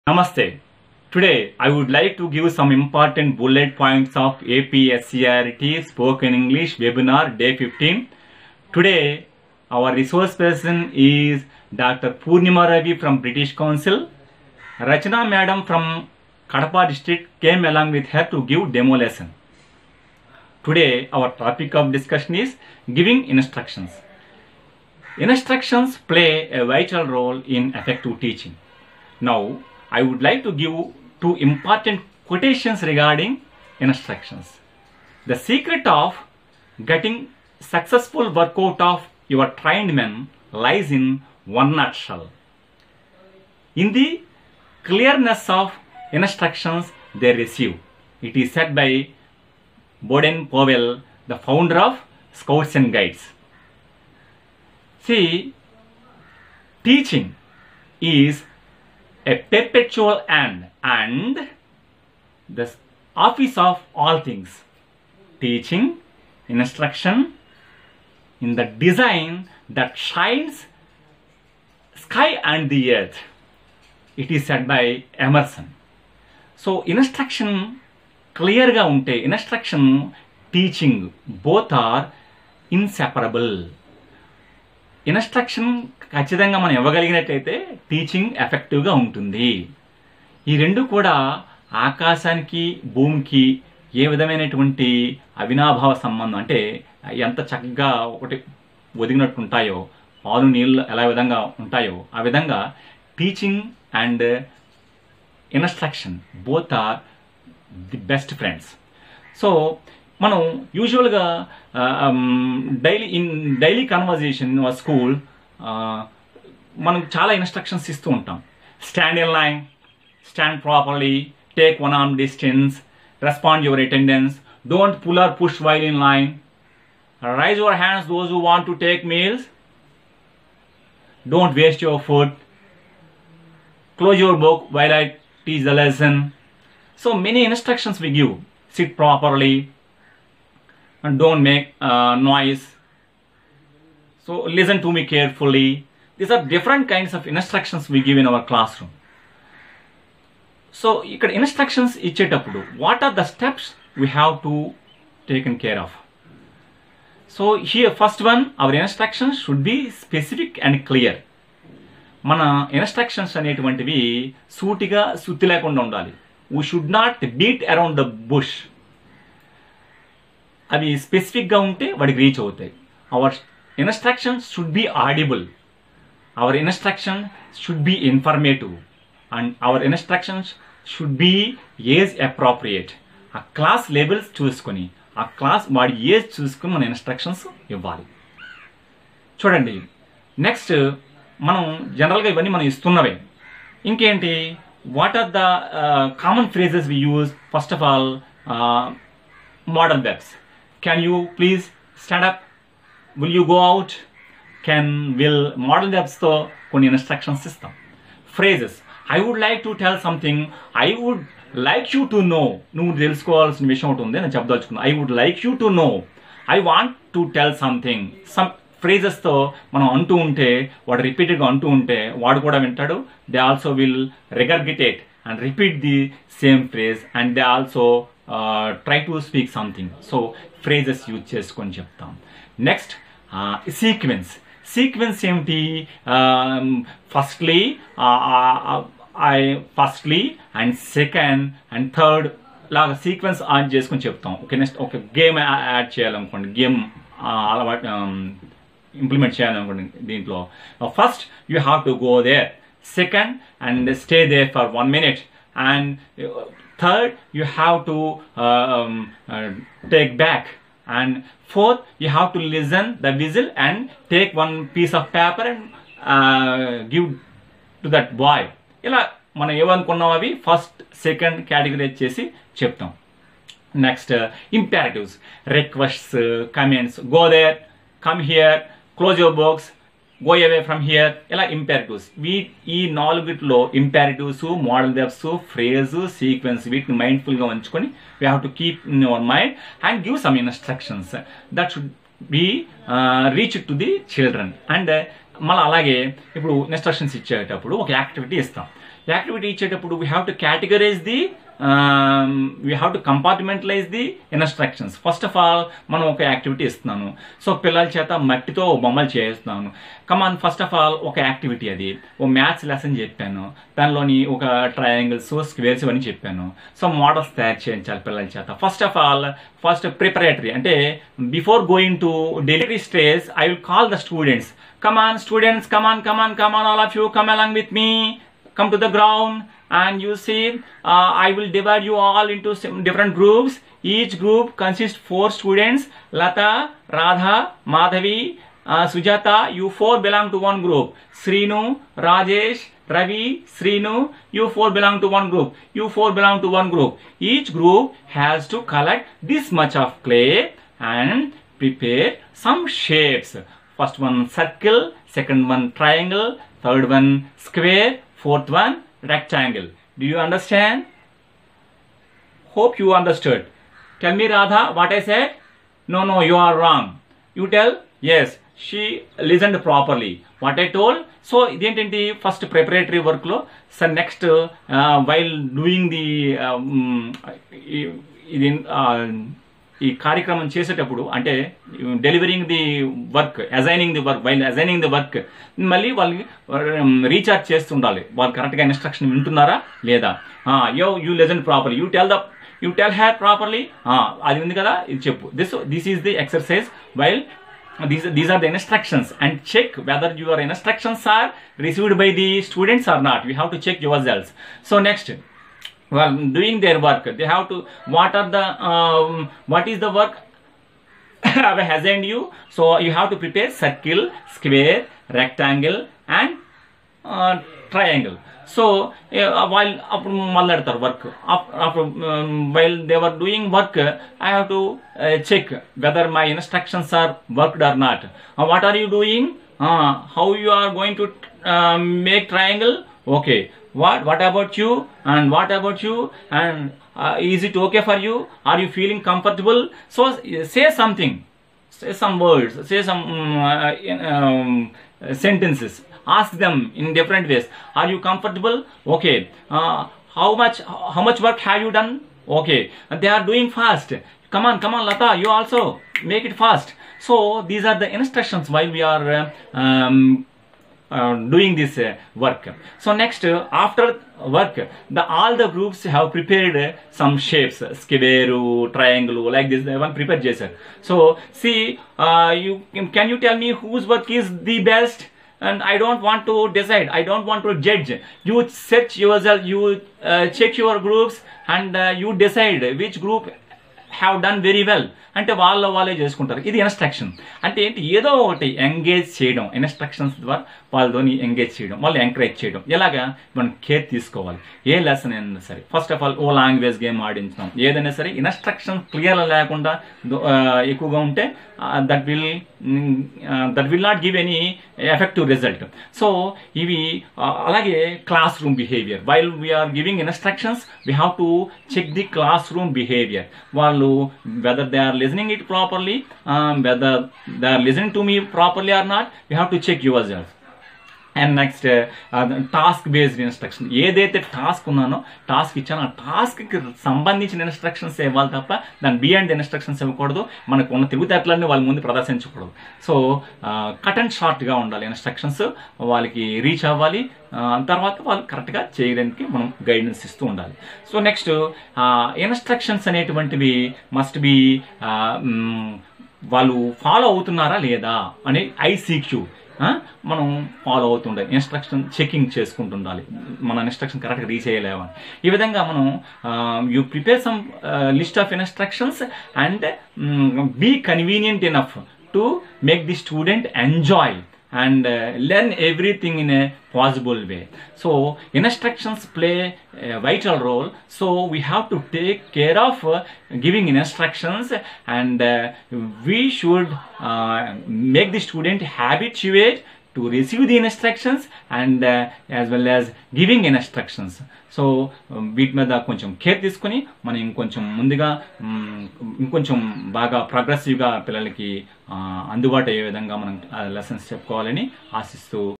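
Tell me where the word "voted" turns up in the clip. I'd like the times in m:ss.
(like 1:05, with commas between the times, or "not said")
not said.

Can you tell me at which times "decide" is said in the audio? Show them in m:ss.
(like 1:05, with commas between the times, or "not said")
7:56, 8:02.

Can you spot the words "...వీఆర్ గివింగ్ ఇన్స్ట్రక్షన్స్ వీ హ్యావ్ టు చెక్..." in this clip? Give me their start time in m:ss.
8:29.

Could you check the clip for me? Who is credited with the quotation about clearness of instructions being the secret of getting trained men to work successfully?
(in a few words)
Baden Powell.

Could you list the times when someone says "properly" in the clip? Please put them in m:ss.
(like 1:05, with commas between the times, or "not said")
6:09.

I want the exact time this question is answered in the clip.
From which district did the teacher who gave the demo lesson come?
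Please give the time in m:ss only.
0:16.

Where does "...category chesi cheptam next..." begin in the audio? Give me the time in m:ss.
4:31.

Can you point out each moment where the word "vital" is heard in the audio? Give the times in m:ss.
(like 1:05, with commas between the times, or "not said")
0:26, 9:29.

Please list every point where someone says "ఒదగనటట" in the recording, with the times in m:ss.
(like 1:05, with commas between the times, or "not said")
1:39.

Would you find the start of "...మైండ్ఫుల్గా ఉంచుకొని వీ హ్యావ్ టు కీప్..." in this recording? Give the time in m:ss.
4:47.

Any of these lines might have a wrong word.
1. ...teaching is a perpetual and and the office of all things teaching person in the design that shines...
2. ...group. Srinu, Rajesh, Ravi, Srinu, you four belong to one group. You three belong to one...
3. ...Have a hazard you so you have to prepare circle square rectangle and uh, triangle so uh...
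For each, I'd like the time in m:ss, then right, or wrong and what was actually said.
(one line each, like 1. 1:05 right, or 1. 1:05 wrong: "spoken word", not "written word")
1. 0:56 wrong: "instruction", not "person"
2. 5:40 wrong: "four", not "three"
3. 6:51 right.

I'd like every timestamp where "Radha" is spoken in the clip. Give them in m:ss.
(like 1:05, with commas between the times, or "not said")
5:36, 6:04.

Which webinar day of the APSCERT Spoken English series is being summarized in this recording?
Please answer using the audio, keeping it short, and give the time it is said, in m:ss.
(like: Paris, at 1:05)
15, at 0:07.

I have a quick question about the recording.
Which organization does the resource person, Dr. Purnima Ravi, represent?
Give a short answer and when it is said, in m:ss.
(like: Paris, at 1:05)
British Council, at 0:13.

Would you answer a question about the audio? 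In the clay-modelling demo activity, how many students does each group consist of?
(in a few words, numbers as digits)
4.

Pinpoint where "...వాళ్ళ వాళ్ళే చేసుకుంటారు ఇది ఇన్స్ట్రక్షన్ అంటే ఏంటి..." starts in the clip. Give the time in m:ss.
8:05.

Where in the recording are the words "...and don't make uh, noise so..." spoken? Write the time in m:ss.
2:21.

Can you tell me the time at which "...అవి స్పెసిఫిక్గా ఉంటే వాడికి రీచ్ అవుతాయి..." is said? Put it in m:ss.
2:50.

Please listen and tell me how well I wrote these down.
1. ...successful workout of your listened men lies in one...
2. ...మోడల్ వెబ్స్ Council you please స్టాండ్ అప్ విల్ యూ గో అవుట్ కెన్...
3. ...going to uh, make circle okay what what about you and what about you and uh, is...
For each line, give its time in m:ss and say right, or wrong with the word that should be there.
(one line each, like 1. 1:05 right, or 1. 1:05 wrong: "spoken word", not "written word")
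1. 0:37 wrong: "trained", not "listened"
2. 3:19 wrong: "Can", not "Council"
3. 7:10 wrong: "triangle", not "circle".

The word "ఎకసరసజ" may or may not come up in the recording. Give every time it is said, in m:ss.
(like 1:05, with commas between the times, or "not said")
6:36.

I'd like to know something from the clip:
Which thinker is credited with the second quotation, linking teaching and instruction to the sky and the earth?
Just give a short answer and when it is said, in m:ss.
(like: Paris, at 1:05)
Emerson, at 1:15.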